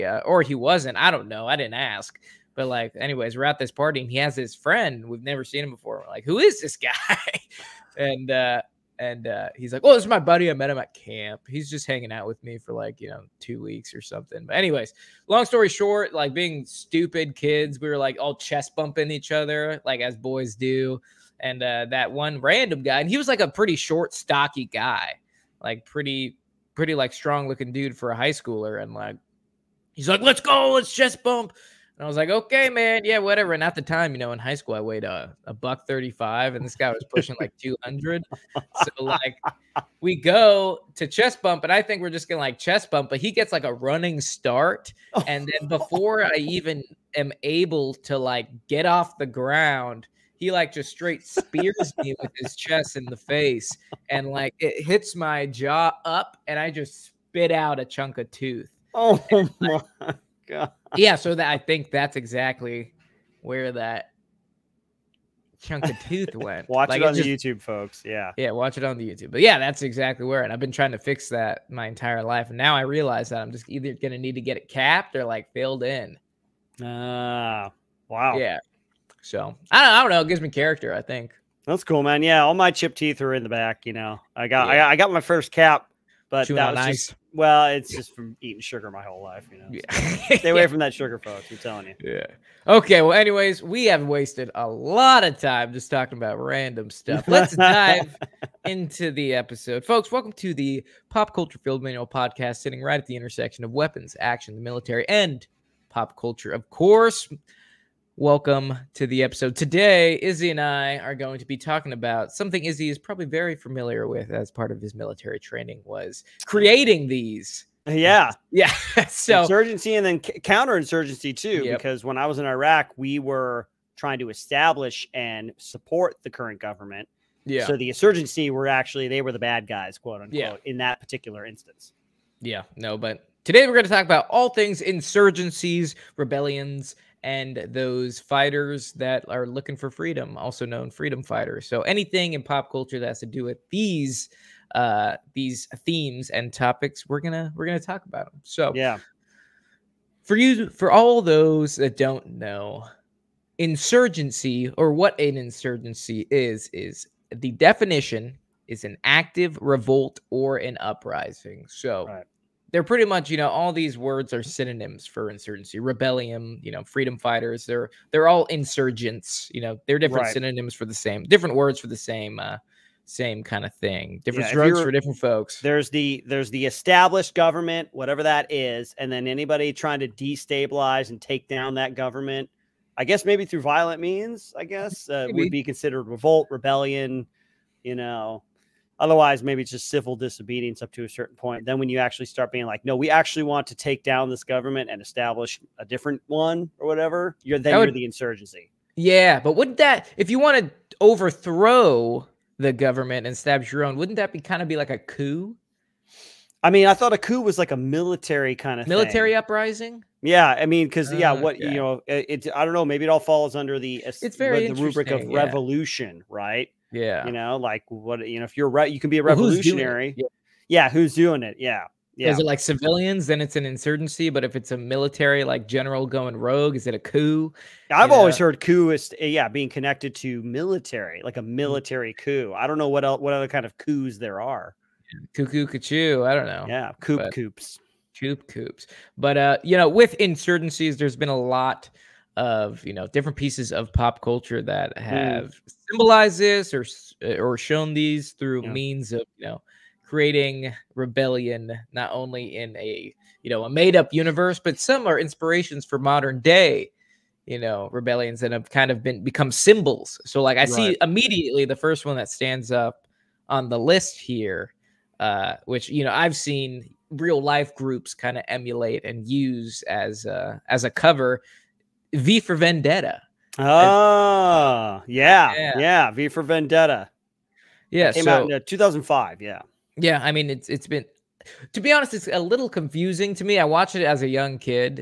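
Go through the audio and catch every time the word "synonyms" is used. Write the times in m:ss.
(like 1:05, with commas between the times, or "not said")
2:44, 2:50.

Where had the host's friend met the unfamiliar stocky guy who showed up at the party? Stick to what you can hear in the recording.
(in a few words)
camp.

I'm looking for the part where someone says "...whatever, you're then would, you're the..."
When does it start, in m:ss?
3:16.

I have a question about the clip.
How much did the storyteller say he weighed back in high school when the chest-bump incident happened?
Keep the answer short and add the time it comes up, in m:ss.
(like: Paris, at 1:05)
135, at 0:35.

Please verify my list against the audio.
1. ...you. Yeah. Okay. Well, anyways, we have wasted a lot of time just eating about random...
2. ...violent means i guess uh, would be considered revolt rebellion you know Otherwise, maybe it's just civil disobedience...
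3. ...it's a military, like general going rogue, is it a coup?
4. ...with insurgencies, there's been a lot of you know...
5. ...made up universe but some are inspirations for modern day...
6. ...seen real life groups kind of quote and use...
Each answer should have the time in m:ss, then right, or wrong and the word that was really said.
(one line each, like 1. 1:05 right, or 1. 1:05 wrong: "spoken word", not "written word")
1. 1:31 wrong: "talking", not "eating"
2. 3:03 right
3. 3:44 right
4. 3:59 right
5. 4:13 right
6. 4:26 wrong: "emulate", not "quote".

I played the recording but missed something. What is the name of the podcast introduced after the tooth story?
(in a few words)
Pop Culture Field Manual.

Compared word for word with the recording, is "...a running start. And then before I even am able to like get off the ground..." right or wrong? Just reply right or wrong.
right.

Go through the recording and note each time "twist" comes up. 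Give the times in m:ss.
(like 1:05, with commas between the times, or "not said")
not said.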